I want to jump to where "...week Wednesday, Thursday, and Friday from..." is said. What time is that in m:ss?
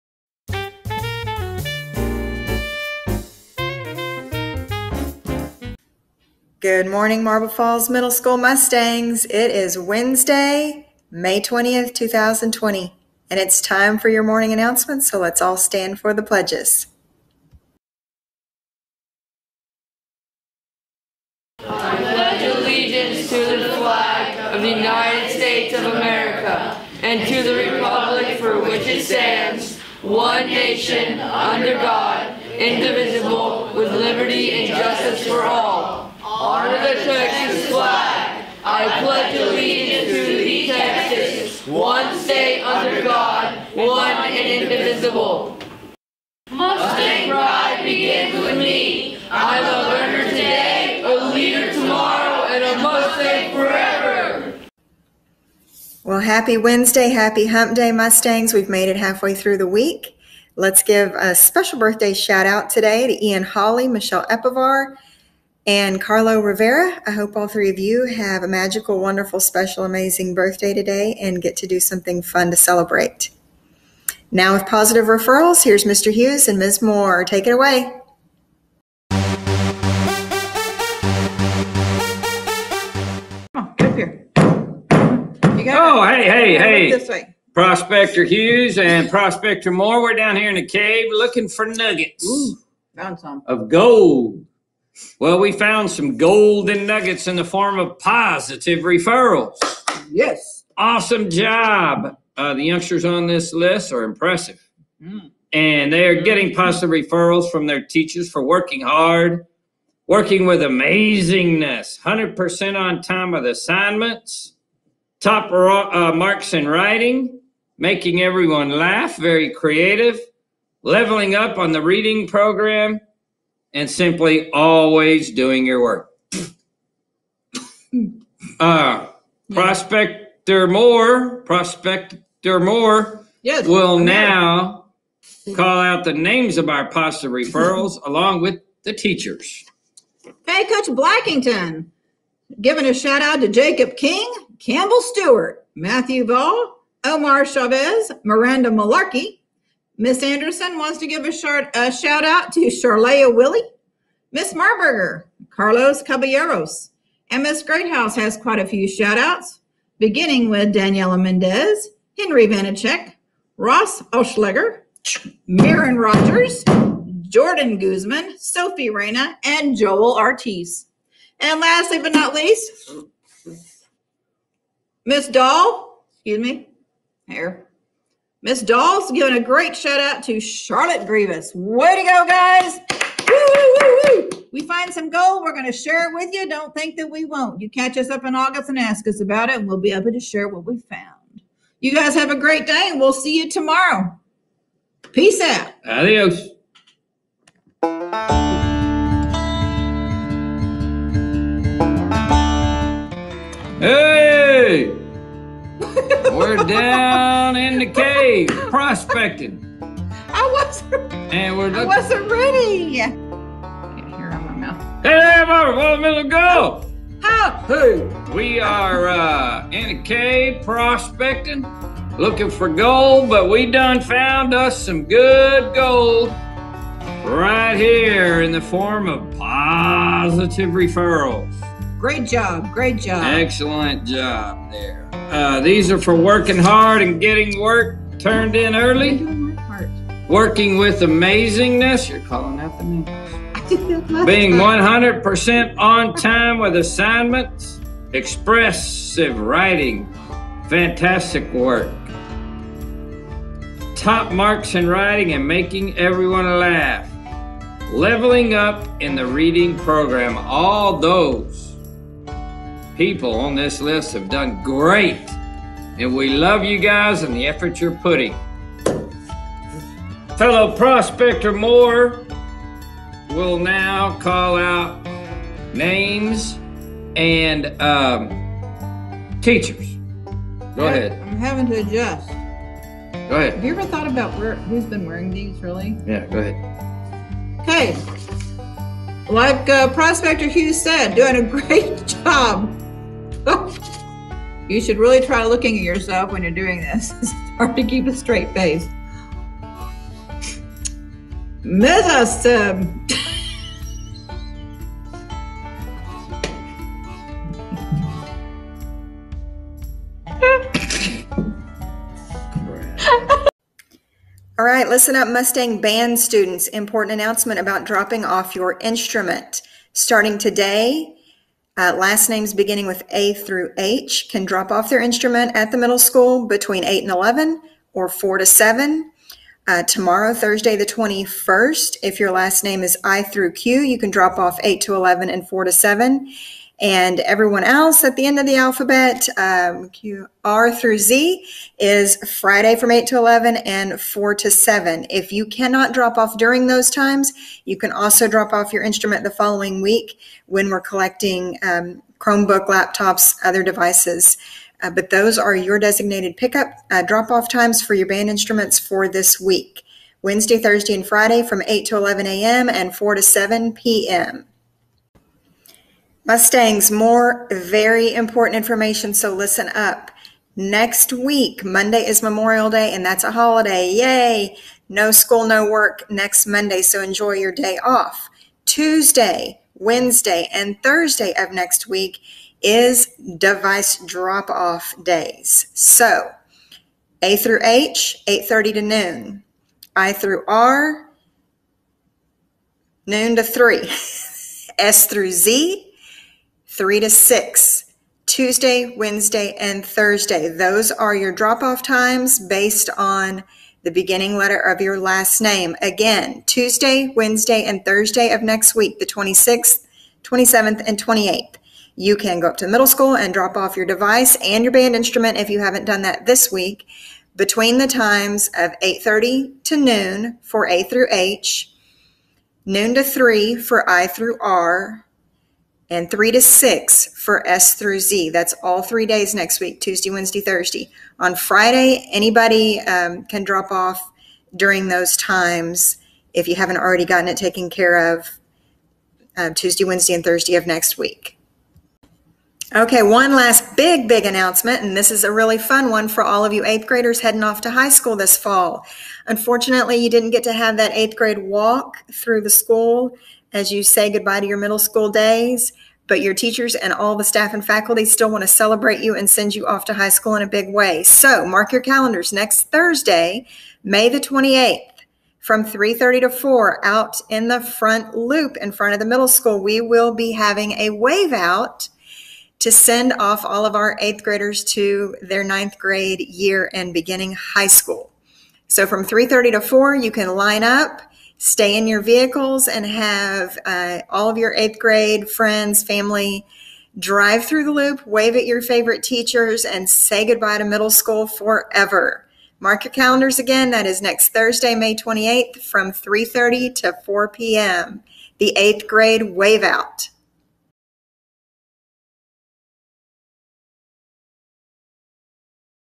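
5:59.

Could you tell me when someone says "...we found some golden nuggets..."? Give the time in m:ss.
1:35.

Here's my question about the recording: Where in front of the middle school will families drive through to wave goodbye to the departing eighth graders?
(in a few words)
The front loop.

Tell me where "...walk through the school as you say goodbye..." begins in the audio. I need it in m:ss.
7:31.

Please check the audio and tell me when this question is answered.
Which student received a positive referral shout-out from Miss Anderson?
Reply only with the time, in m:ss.
2:32.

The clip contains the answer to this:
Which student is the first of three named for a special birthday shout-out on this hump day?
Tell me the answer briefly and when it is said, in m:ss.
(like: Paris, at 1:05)
Ian Holly, at 1:03.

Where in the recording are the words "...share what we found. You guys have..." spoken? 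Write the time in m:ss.
3:10.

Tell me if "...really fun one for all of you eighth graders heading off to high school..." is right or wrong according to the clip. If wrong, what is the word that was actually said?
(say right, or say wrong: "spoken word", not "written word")
right.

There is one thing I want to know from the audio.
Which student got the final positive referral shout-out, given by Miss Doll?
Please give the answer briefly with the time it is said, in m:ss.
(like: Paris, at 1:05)
Charlotte Grievous, at 3:00.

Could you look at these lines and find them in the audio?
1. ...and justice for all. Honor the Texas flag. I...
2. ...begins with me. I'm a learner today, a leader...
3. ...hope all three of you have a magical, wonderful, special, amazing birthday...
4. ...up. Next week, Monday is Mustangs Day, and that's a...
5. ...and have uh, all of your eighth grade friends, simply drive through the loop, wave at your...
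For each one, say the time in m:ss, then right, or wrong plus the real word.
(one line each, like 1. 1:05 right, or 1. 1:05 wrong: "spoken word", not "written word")
1. 0:34 right
2. 0:47 right
3. 1:07 right
4. 6:09 wrong: "Memorial", not "Mustangs"
5. 8:02 wrong: "family", not "simply".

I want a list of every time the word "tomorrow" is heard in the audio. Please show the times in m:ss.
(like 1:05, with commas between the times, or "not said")
0:51, 3:13, 5:29.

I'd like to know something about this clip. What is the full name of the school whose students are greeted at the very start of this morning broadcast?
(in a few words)
Marble Falls Middle School.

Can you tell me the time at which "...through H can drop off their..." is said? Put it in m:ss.
5:23.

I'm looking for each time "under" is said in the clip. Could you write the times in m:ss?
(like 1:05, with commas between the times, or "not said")
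0:31, 0:42.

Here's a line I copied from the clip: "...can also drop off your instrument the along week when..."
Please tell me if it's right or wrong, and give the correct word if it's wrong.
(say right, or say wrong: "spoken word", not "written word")
wrong: "following", not "along".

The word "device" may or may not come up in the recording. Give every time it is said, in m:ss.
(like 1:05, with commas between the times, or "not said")
5:53, 6:23, 6:53.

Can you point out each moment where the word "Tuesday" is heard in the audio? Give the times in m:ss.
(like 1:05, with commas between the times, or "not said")
6:18, 6:38, 6:46, 7:09, 7:19.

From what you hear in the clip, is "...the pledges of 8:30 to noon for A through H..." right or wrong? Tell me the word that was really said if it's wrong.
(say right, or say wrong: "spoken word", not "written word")
wrong: "times", not "pledges".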